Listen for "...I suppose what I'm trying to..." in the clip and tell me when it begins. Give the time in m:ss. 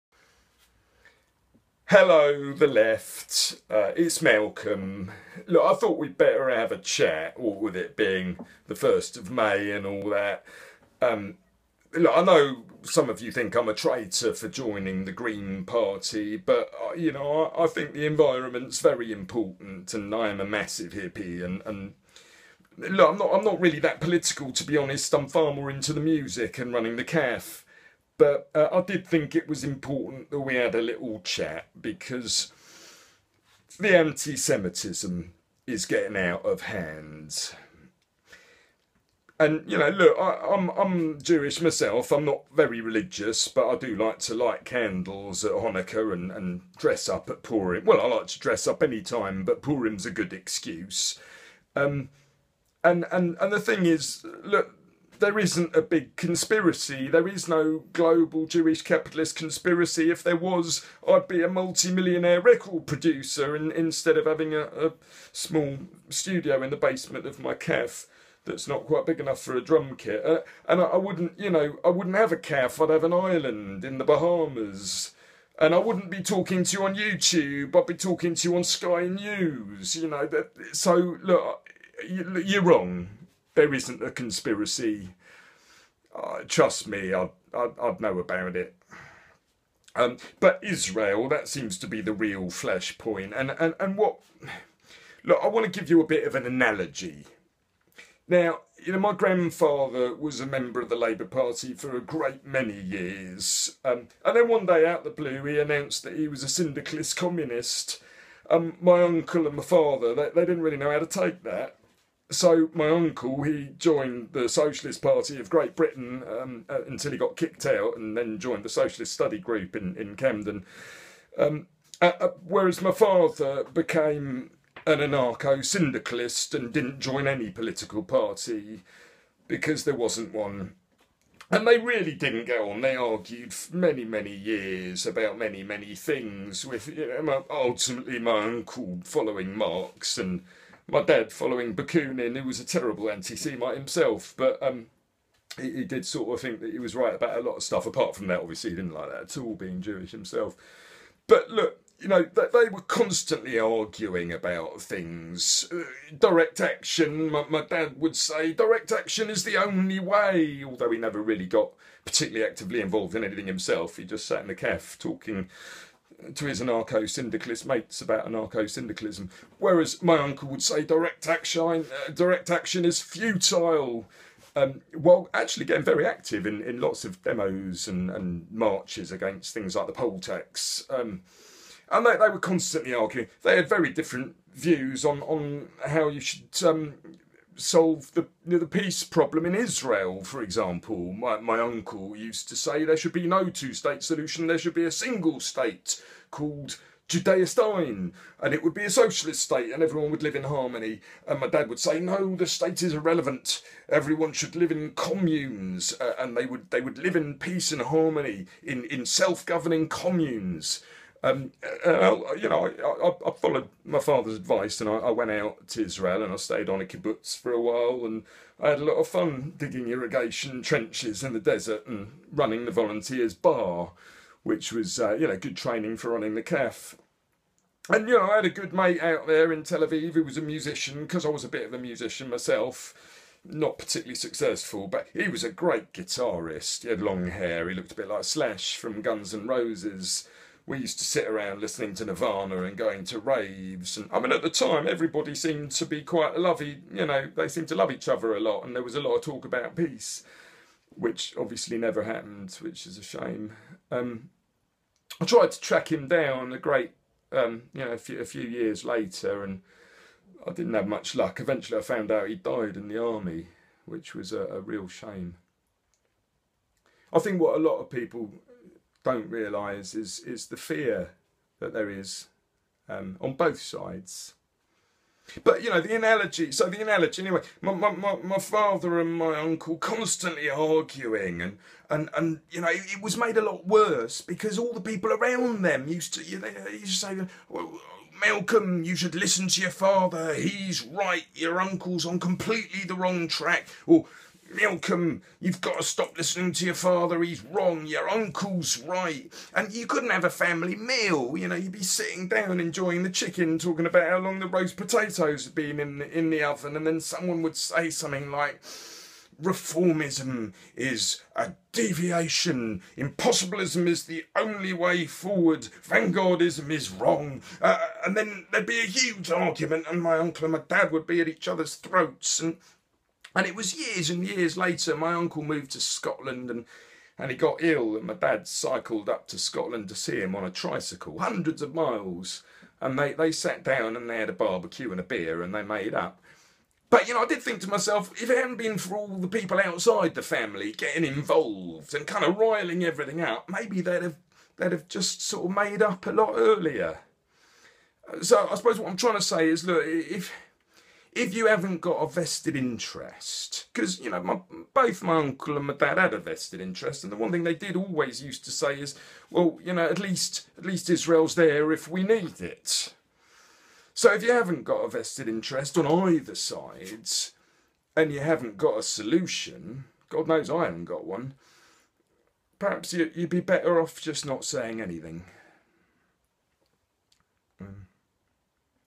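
5:48.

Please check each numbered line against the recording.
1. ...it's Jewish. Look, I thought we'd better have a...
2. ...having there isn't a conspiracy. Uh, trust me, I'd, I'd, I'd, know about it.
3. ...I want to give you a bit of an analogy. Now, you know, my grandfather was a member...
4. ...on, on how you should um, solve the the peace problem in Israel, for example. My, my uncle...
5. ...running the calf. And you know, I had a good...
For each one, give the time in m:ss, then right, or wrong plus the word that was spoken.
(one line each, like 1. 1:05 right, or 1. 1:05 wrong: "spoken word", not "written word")
1. 0:03 wrong: "Malcolm", not "Jewish"
2. 1:22 wrong: "wrong", not "having"
3. 1:35 right
4. 3:05 right
5. 3:46 right.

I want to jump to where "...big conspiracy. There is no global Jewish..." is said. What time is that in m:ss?
0:55.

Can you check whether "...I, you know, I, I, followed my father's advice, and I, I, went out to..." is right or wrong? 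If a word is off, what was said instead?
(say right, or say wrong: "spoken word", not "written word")
right.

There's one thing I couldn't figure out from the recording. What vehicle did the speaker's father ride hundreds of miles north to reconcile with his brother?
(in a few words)
tricycle.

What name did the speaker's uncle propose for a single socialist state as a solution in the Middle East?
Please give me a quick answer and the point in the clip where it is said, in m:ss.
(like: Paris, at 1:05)
Judea-Stein, at 3:17.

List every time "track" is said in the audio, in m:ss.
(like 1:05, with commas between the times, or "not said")
4:15, 4:53.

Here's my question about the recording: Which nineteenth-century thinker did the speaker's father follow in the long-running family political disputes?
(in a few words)
Bakunin.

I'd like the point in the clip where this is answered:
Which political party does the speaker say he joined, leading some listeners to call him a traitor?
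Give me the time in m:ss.
0:15.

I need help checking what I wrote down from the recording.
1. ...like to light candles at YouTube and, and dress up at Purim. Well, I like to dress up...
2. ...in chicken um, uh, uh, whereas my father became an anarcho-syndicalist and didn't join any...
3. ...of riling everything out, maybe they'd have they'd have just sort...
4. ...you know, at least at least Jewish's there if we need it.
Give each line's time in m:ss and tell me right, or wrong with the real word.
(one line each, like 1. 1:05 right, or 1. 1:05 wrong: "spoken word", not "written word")
1. 0:43 wrong: "Hanukkah", not "YouTube"
2. 1:59 wrong: "camden", not "chicken"
3. 5:42 right
4. 5:59 wrong: "Israel", not "Jewish".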